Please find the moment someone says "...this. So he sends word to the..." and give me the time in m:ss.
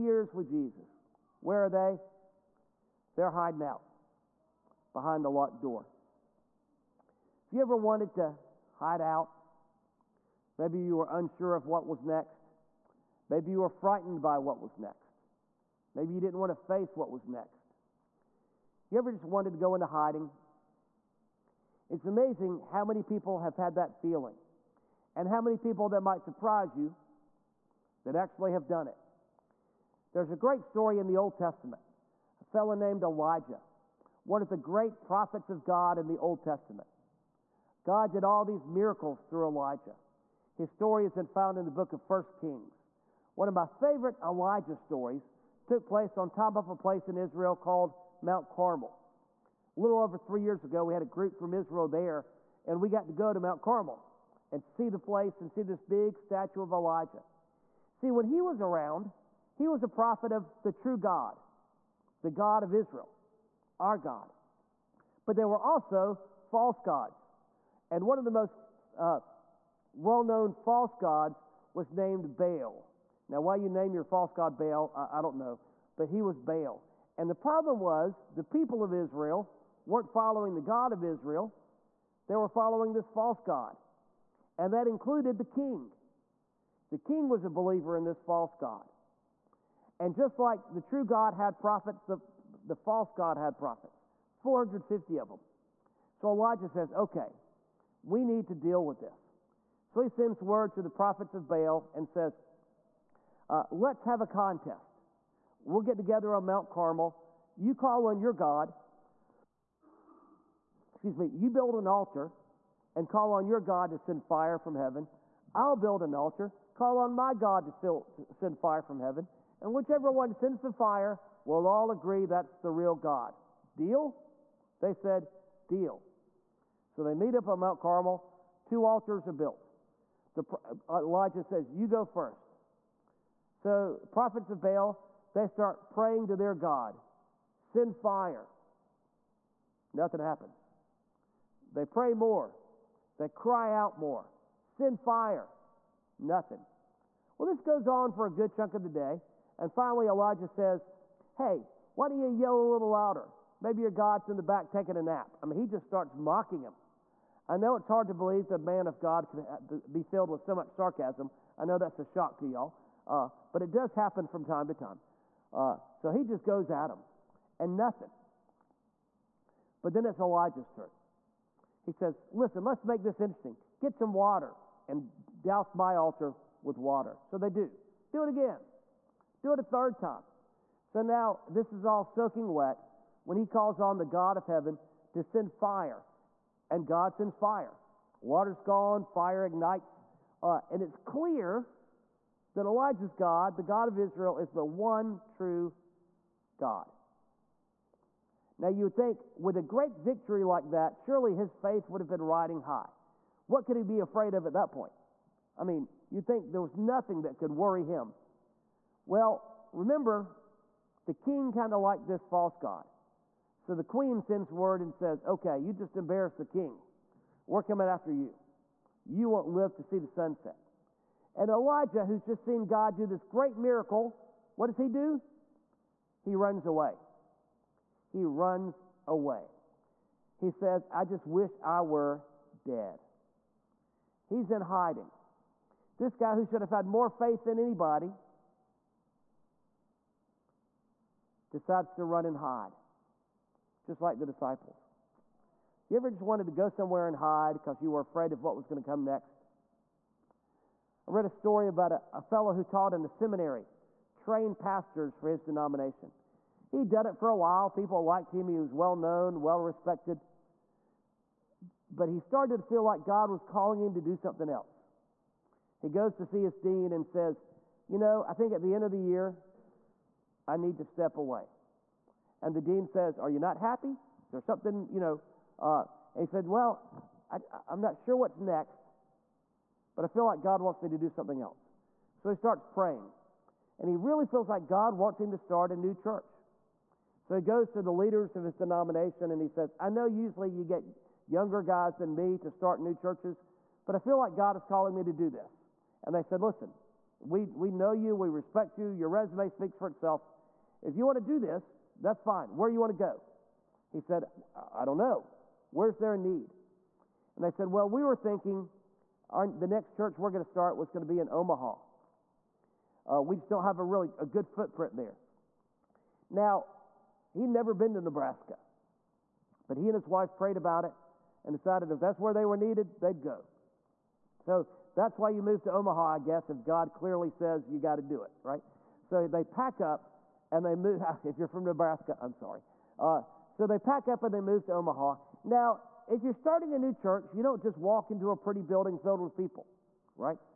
1:38.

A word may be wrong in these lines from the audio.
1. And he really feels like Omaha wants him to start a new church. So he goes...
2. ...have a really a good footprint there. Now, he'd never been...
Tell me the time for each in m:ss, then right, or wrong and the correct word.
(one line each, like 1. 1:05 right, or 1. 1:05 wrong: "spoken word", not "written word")
1. 4:43 wrong: "God", not "Omaha"
2. 5:13 right.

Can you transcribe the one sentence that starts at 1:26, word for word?
The king was a believer in this false god.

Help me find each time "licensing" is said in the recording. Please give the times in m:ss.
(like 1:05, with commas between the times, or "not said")
not said.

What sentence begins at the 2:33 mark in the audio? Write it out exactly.
Maybe your God's in the back taking a nap.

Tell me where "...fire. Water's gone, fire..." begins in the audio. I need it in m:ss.
3:07.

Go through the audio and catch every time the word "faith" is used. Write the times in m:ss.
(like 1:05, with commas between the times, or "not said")
3:21, 3:57.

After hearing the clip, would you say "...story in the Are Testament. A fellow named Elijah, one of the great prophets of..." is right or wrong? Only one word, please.
wrong.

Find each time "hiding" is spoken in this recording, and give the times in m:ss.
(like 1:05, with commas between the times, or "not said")
0:03, 0:19, 3:54.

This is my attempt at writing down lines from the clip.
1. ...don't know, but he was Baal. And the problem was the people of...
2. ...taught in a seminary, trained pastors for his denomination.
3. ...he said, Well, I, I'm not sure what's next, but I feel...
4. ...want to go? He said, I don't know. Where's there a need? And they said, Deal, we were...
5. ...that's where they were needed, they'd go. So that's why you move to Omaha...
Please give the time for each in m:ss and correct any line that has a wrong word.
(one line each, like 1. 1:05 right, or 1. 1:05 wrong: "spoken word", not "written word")
1. 1:15 right
2. 4:12 right
3. 4:36 right
4. 5:02 wrong: "Well", not "Deal"
5. 5:21 right.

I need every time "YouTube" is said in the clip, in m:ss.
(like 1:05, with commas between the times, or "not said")
not said.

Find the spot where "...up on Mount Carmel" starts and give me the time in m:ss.
2:07.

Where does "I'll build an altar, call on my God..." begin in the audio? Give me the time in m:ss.
1:55.